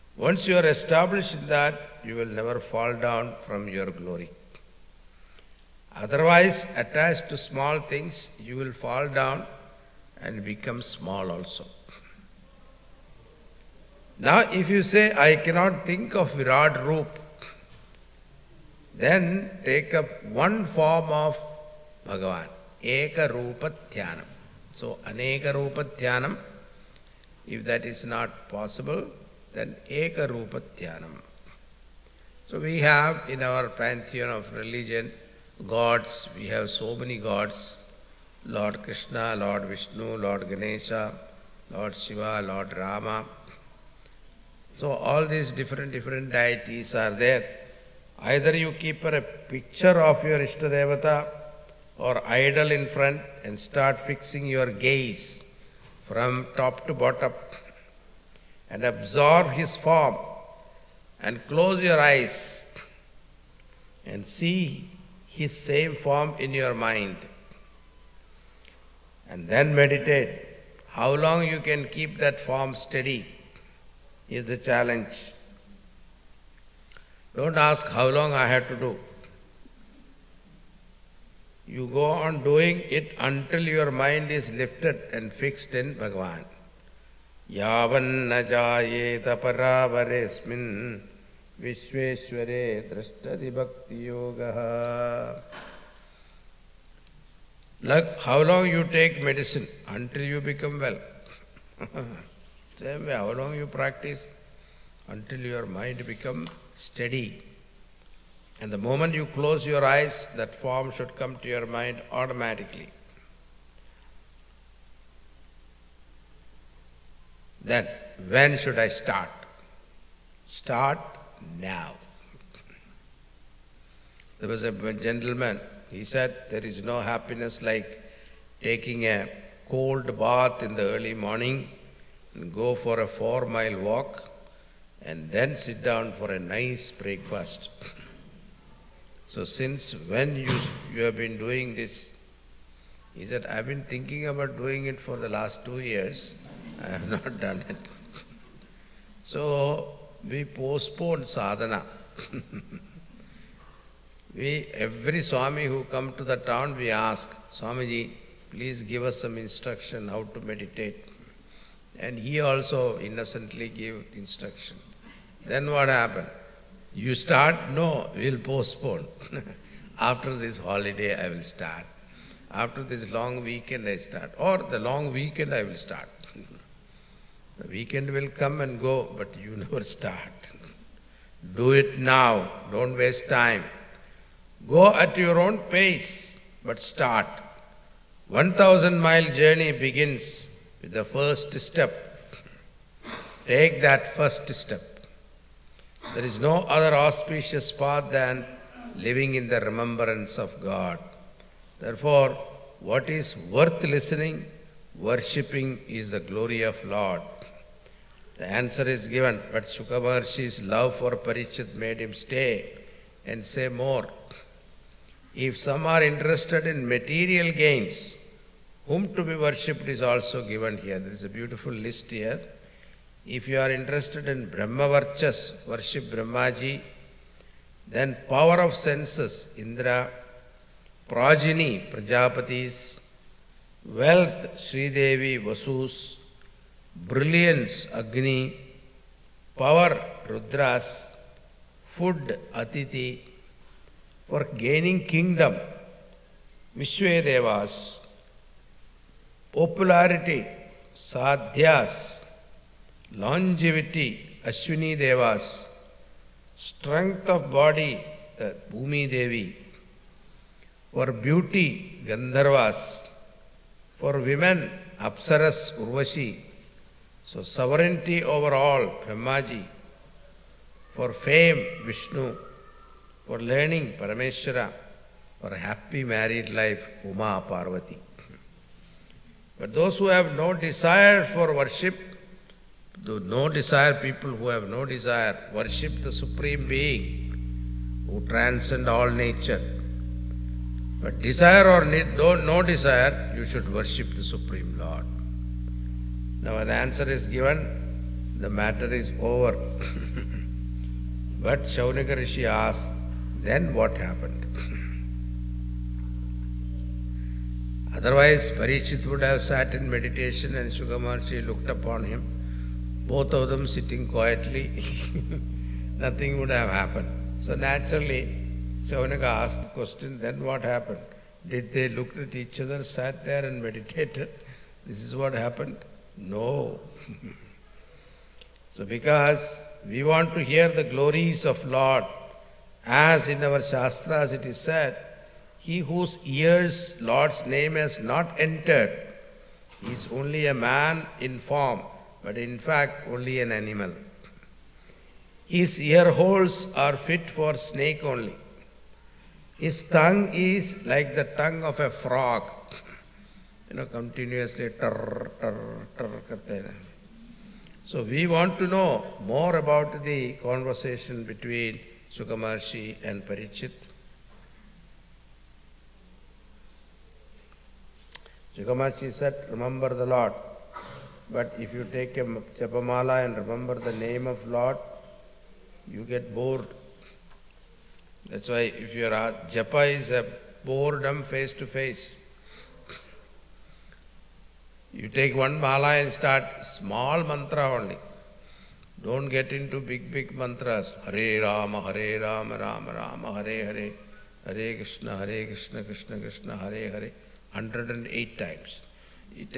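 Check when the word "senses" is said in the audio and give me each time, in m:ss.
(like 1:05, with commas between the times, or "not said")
3:48.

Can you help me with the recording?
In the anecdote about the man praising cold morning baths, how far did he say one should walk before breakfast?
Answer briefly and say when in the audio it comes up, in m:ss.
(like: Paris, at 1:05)
4 miles, at 2:13.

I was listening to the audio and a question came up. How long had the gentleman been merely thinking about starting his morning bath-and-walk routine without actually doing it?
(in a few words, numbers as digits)
2 years.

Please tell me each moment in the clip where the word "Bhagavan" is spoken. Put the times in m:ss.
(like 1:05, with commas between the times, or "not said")
0:22, 1:26.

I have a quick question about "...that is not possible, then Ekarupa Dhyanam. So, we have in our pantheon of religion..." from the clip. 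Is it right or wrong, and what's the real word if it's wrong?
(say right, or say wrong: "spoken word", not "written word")
right.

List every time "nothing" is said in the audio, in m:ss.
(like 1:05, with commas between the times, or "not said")
5:15.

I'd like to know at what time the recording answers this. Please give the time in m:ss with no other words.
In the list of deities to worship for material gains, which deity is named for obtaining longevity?
4:14.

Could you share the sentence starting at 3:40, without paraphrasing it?
There is a beautiful list here.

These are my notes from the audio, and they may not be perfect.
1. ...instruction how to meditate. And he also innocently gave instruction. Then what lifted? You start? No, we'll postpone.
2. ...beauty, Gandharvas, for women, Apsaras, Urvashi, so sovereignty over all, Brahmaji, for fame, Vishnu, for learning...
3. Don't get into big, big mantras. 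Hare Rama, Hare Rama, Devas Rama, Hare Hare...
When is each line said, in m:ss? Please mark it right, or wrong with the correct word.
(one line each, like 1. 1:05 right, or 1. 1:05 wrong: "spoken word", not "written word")
1. 2:39 wrong: "happened", not "lifted"
2. 4:21 right
3. 6:29 wrong: "Rama", not "Devas".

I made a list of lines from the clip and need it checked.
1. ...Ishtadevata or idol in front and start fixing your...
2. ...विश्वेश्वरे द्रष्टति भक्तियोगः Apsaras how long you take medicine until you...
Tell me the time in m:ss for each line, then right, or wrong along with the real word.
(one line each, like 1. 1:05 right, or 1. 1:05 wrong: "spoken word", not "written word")
1. 0:50 right
2. 1:31 wrong: "Like", not "Apsaras".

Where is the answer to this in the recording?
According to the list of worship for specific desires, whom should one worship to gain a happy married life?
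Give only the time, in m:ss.
4:37.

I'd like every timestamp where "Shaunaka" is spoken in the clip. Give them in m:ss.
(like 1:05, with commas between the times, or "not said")
5:01, 5:18.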